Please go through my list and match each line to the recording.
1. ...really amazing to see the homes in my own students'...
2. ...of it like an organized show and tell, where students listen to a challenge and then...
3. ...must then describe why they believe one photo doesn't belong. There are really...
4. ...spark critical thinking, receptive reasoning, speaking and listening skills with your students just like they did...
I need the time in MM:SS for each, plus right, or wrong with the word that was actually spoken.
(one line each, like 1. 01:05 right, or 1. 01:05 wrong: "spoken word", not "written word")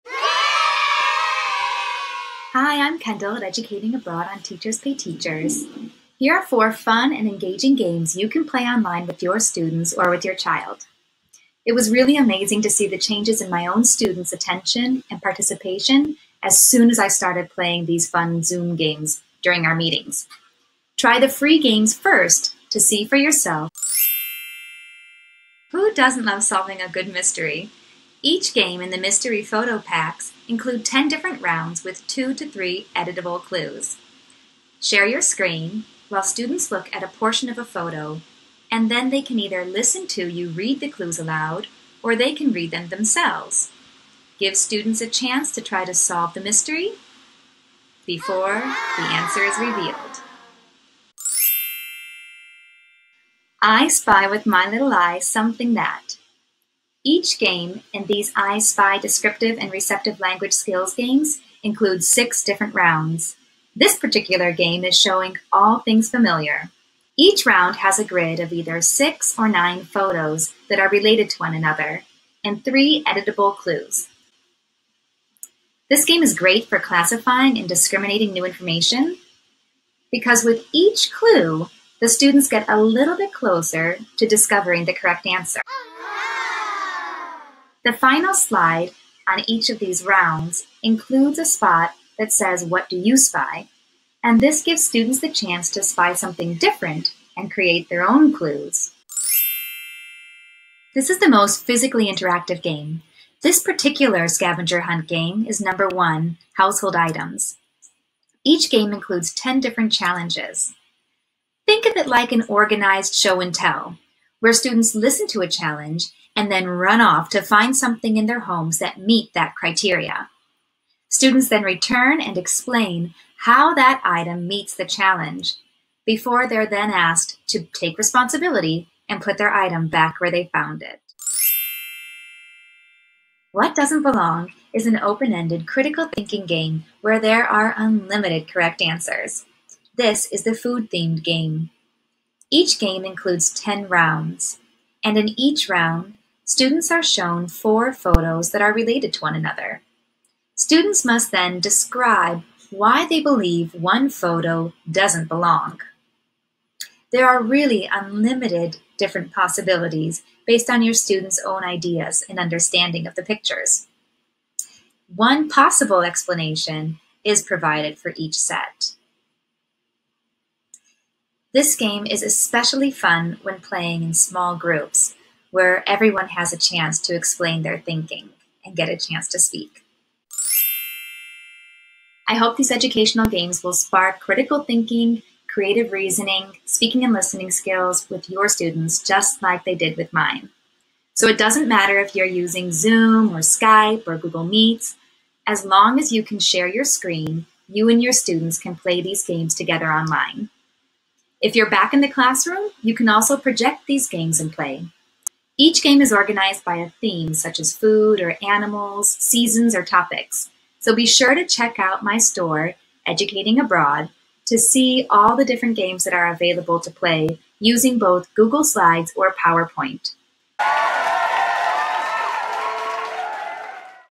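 1. 00:11 wrong: "changes", not "homes"
2. 01:51 right
3. 02:31 right
4. 03:03 wrong: "creative", not "receptive".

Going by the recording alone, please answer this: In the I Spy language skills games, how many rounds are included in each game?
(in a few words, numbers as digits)
6.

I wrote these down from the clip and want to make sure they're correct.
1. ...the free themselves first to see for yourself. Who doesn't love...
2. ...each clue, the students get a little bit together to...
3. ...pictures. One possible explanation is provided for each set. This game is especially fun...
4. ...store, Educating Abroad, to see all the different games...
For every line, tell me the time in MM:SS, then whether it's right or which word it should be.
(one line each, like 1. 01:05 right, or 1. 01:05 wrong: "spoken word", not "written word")
1. 00:21 wrong: "games", not "themselves"
2. 01:20 wrong: "closer", not "together"
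3. 02:43 right
4. 03:32 right.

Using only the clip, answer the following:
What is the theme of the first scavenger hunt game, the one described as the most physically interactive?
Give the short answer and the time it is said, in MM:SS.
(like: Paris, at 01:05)
Household Items, at 01:46.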